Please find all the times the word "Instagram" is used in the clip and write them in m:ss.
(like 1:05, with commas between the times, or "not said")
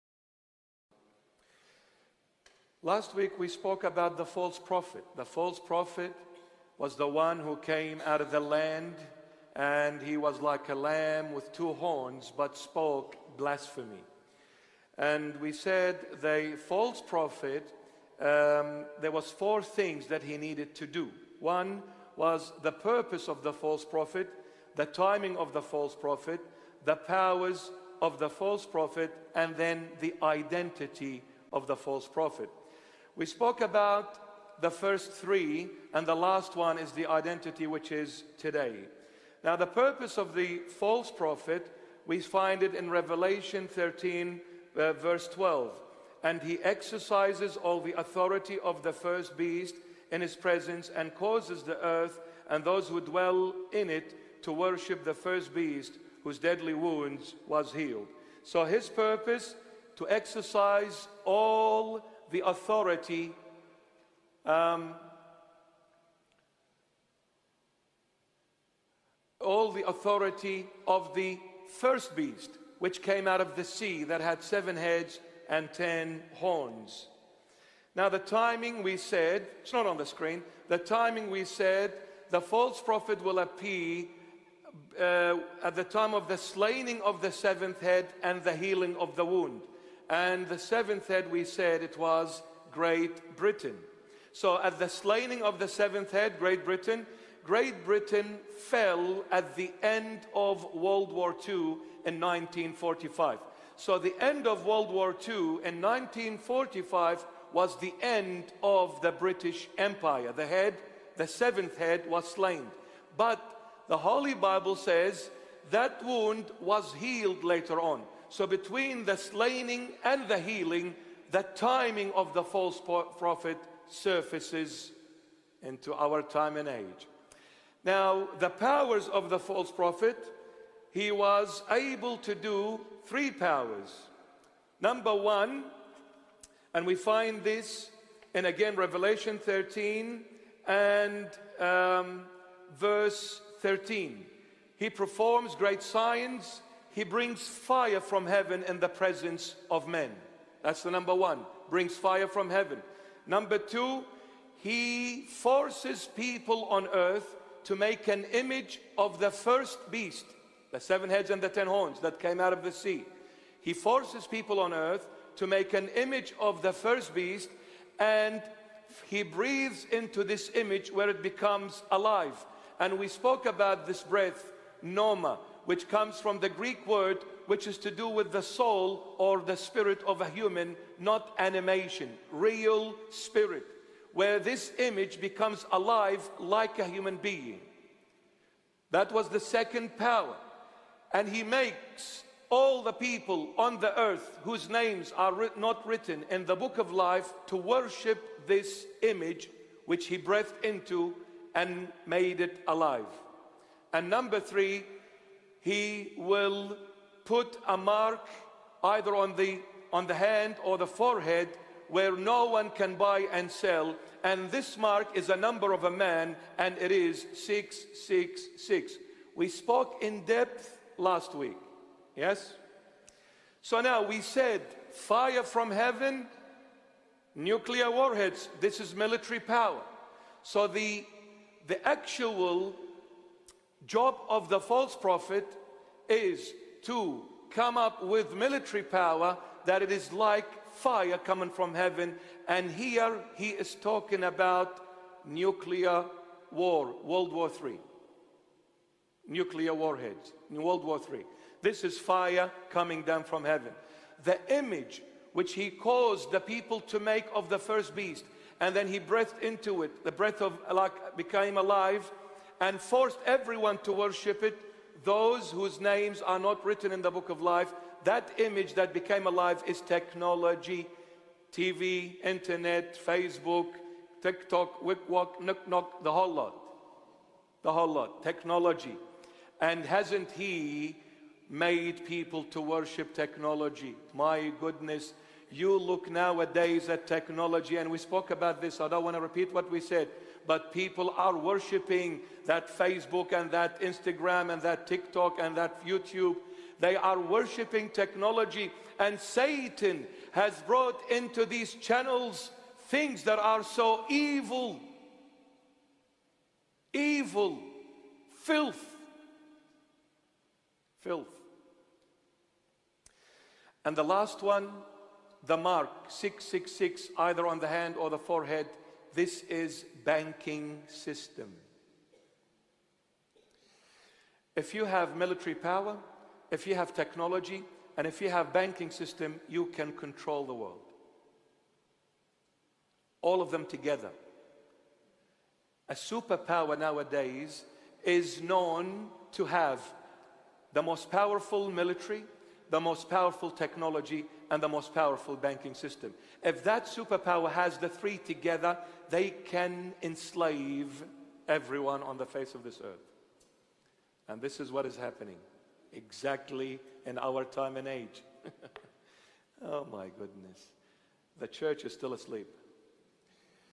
4:53.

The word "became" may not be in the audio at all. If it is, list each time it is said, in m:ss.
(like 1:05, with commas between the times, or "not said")
4:21, 4:28.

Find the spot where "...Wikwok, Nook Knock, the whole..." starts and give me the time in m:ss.
4:34.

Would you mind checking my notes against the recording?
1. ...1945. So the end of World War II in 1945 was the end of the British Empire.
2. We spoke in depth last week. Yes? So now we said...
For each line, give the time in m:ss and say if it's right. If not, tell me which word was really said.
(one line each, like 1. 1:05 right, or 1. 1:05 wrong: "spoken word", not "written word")
1. 1:42 right
2. 3:39 right.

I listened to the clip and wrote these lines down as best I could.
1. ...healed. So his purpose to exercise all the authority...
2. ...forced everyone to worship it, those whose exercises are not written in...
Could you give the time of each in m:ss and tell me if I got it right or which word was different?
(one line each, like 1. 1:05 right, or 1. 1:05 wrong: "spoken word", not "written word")
1. 0:57 right
2. 4:22 wrong: "names", not "exercises".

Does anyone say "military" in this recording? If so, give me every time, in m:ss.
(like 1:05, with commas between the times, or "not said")
3:48, 3:58, 5:25, 5:41.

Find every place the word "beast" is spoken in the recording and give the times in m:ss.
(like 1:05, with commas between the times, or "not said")
0:49, 0:55, 1:12, 2:39, 2:47, 4:17.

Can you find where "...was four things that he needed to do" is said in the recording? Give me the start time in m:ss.
0:19.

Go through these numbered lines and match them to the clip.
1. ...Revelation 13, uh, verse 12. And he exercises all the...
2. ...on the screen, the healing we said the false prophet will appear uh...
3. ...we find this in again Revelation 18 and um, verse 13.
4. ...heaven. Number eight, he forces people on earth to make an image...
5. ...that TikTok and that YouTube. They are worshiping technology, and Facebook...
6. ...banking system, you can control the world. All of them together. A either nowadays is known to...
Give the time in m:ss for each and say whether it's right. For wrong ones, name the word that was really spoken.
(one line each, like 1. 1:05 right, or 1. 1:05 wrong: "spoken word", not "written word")
1. 0:42 right
2. 1:19 wrong: "timing", not "healing"
3. 2:16 wrong: "13", not "18"
4. 2:32 wrong: "two", not "eight"
5. 4:54 wrong: "Satan", not "Facebook"
6. 5:28 wrong: "superpower", not "either".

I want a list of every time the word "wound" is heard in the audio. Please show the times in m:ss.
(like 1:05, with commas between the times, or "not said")
0:56, 1:29, 1:56.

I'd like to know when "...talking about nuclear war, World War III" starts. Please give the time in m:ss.
4:03.